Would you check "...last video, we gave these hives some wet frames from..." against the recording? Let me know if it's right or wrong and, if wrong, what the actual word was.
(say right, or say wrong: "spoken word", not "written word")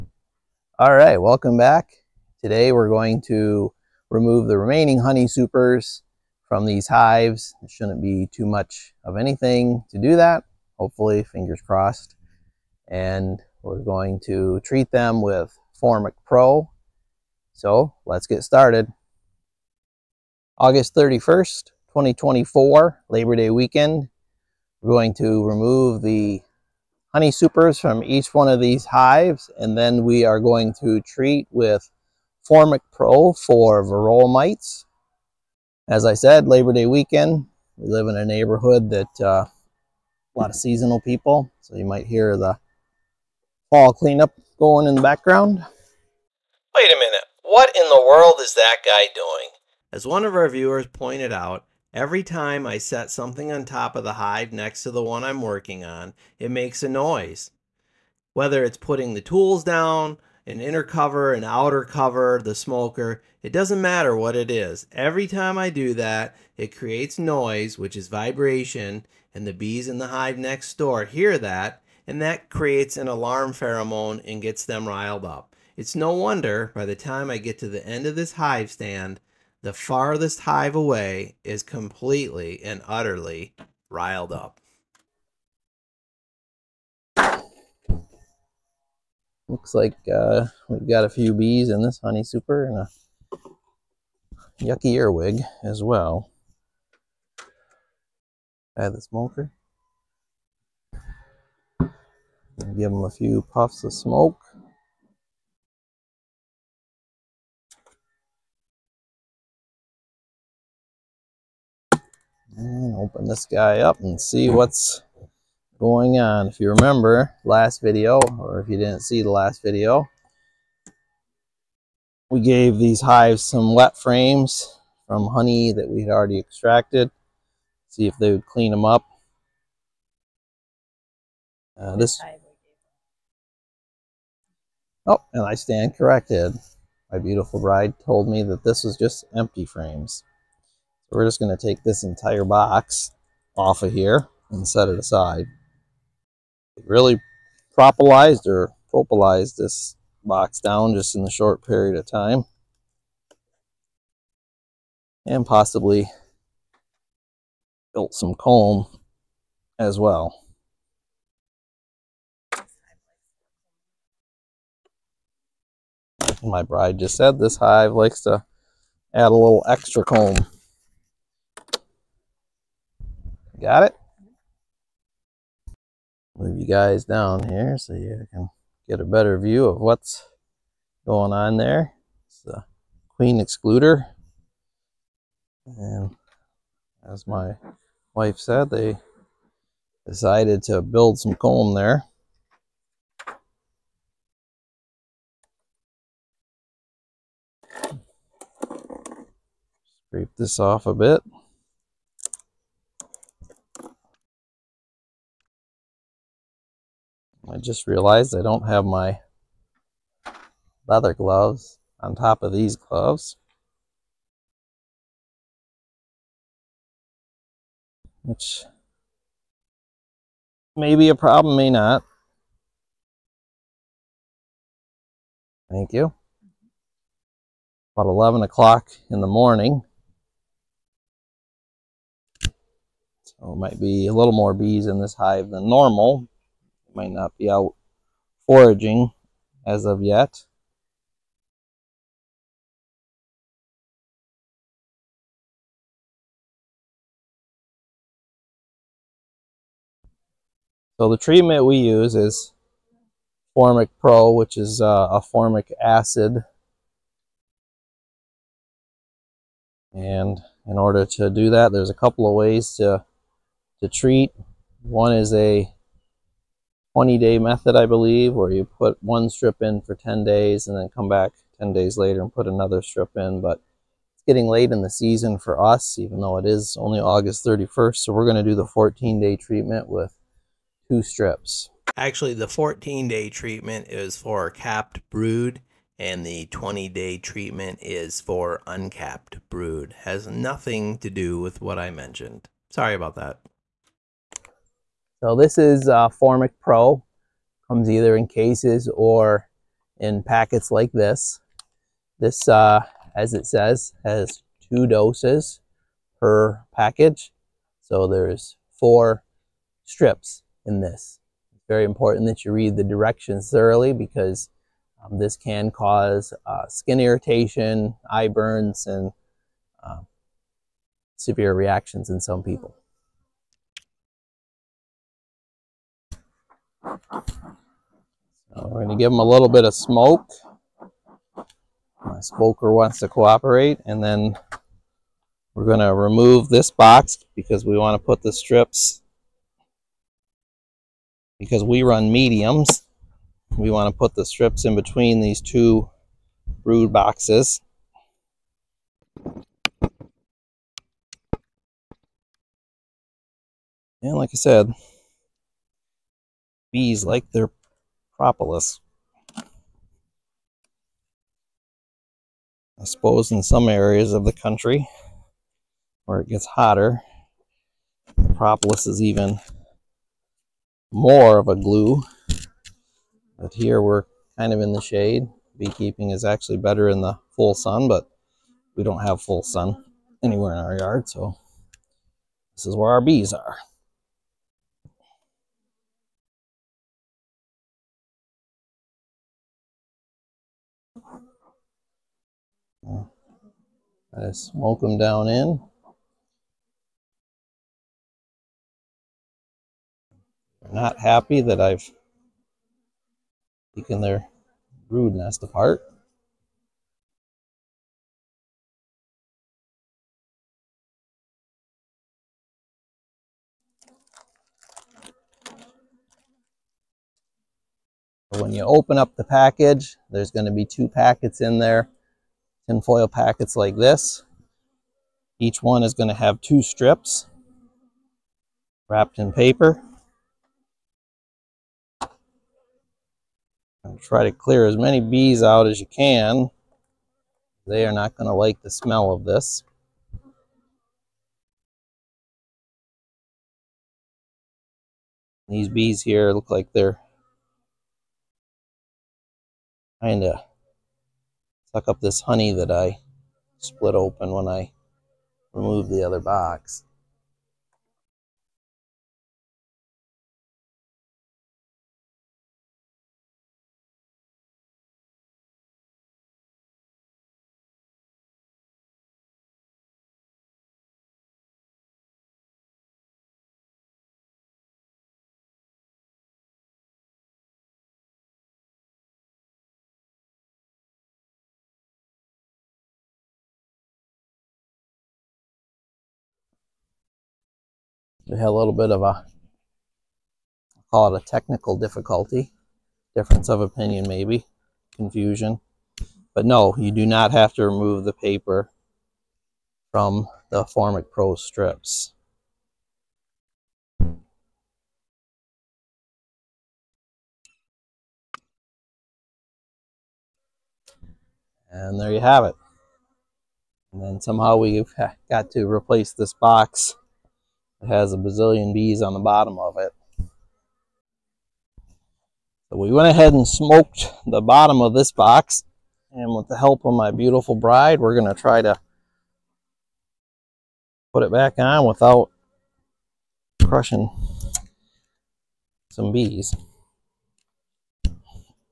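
right.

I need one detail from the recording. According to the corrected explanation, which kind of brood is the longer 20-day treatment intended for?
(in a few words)
uncapped brood.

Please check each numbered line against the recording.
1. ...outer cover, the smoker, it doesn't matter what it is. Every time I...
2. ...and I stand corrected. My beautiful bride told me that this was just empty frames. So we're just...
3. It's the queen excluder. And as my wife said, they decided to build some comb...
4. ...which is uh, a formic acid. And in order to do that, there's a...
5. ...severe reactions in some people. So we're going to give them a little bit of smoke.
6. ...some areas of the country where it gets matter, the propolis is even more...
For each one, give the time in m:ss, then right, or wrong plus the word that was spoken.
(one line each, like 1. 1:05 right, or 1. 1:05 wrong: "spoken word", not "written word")
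1. 1:01 right
2. 2:15 right
3. 3:02 right
4. 4:14 right
5. 5:21 right
6. 6:03 wrong: "hotter", not "matter".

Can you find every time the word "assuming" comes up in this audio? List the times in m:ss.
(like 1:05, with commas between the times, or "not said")
not said.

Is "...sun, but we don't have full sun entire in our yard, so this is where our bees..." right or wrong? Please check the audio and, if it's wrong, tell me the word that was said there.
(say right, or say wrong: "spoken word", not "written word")
wrong: "anywhere", not "entire".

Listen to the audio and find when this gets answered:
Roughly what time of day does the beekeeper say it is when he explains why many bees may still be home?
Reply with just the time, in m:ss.
3:48.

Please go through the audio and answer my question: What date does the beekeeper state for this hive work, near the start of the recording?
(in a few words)
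August 31st, 2024.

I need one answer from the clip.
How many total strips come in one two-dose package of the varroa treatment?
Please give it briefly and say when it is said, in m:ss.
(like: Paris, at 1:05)
4, at 5:08.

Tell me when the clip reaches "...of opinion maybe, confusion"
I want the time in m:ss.
8:13.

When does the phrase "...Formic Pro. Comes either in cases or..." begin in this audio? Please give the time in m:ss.
4:56.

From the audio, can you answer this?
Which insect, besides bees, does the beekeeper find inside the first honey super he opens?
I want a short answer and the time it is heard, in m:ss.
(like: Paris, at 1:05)
earwig, at 1:34.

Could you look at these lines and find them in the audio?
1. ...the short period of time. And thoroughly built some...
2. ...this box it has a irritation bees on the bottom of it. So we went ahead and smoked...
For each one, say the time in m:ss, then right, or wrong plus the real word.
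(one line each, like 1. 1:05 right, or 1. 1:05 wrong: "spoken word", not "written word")
1. 2:31 wrong: "possibly", not "thoroughly"
2. 8:36 wrong: "bazillion", not "irritation".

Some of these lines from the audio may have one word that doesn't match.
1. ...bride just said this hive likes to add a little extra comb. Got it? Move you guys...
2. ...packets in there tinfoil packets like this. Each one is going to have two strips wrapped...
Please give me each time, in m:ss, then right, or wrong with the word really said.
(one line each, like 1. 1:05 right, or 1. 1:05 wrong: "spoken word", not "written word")
1. 2:46 right
2. 7:00 right.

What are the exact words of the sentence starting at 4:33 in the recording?
But it's getting late in the season for us, even though it is only August 31st.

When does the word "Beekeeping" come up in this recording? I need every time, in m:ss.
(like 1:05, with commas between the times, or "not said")
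6:15.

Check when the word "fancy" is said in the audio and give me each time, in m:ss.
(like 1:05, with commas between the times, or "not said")
not said.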